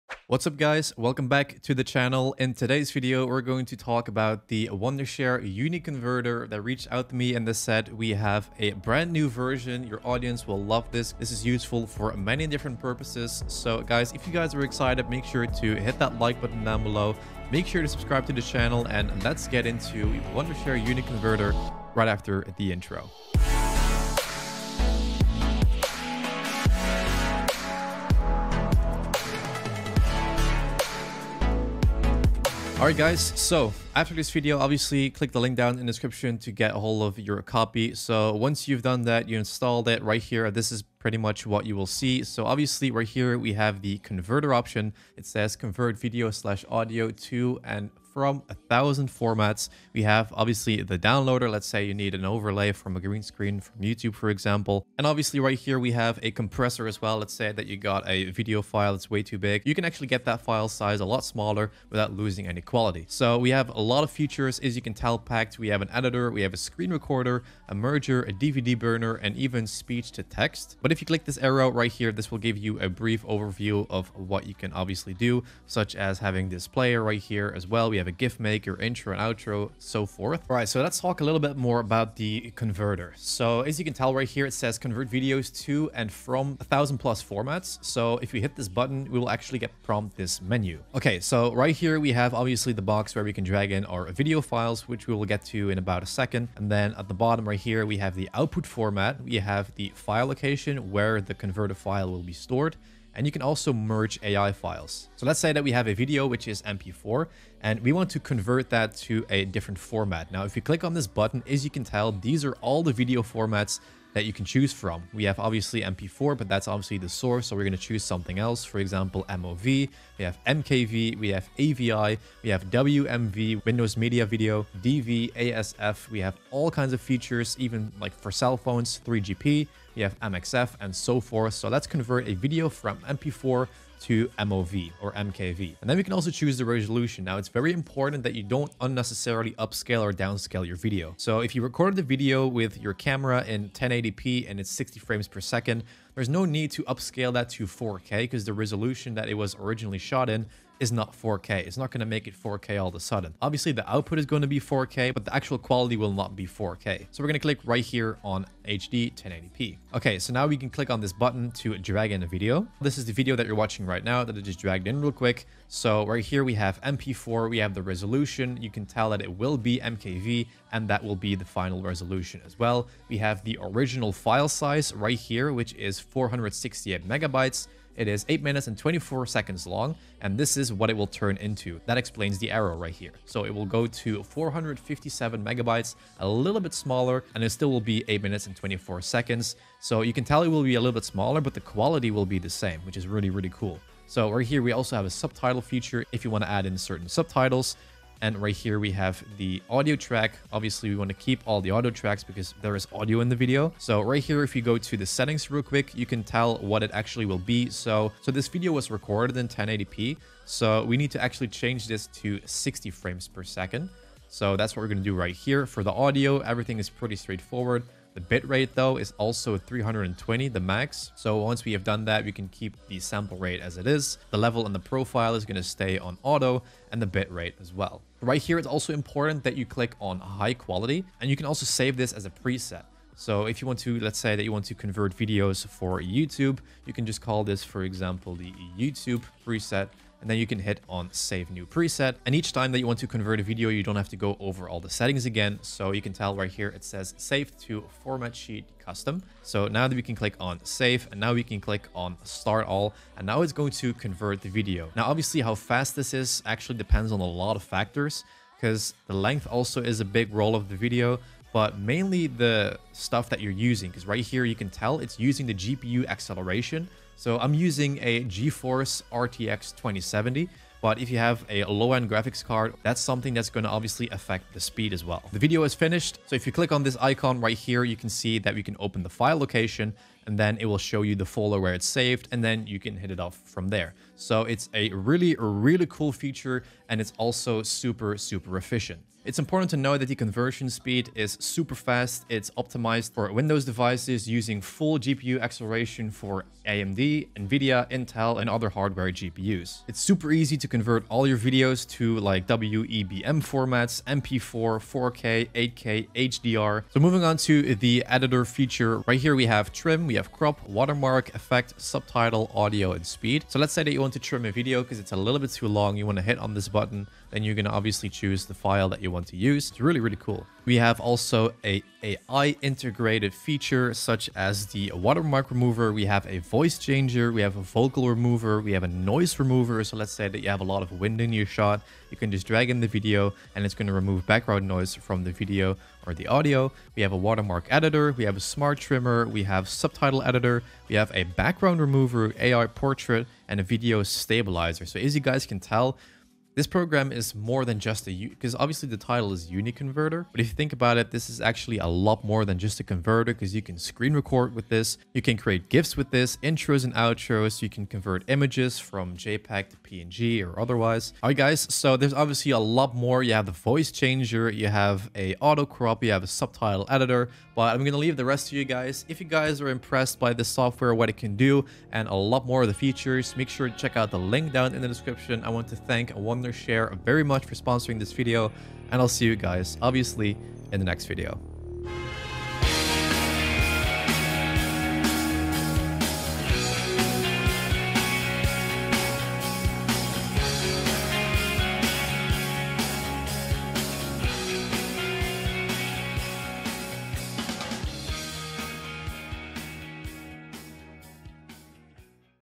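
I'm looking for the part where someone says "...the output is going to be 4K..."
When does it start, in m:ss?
2:33.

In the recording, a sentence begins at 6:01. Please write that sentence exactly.
All right guys, so there's obviously a lot more.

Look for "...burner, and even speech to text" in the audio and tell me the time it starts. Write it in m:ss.
1:08.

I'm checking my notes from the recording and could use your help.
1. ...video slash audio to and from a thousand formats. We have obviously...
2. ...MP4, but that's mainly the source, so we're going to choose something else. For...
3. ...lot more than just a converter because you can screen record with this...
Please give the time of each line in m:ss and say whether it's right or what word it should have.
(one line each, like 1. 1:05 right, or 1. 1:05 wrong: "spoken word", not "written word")
1. 0:45 right
2. 1:55 wrong: "obviously", not "mainly"
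3. 5:51 right.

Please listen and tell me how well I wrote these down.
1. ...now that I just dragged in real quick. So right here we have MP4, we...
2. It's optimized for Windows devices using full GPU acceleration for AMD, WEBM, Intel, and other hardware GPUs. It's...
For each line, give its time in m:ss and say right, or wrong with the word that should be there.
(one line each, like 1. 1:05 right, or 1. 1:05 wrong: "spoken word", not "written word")
1. 2:44 right
2. 4:52 wrong: "NVIDIA", not "WEBM".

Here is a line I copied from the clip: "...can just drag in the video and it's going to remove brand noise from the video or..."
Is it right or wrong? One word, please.
wrong.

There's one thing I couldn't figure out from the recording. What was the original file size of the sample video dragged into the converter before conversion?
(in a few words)
468 megabytes.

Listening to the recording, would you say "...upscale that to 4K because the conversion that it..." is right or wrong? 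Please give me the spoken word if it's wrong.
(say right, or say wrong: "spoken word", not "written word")
wrong: "resolution", not "conversion".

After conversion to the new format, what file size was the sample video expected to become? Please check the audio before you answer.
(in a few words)
457 megabytes.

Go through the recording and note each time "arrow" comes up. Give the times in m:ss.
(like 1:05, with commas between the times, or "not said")
1:11, 3:02.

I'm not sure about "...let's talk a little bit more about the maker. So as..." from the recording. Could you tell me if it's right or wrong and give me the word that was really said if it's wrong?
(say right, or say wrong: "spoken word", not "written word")
wrong: "converter", not "maker".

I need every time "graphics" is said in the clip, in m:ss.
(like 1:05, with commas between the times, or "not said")
4:32.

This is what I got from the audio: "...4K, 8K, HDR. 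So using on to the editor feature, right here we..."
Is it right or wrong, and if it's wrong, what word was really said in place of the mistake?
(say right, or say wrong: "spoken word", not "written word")
wrong: "moving", not "using".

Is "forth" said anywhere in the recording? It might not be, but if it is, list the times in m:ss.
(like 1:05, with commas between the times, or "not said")
1:20, 2:11.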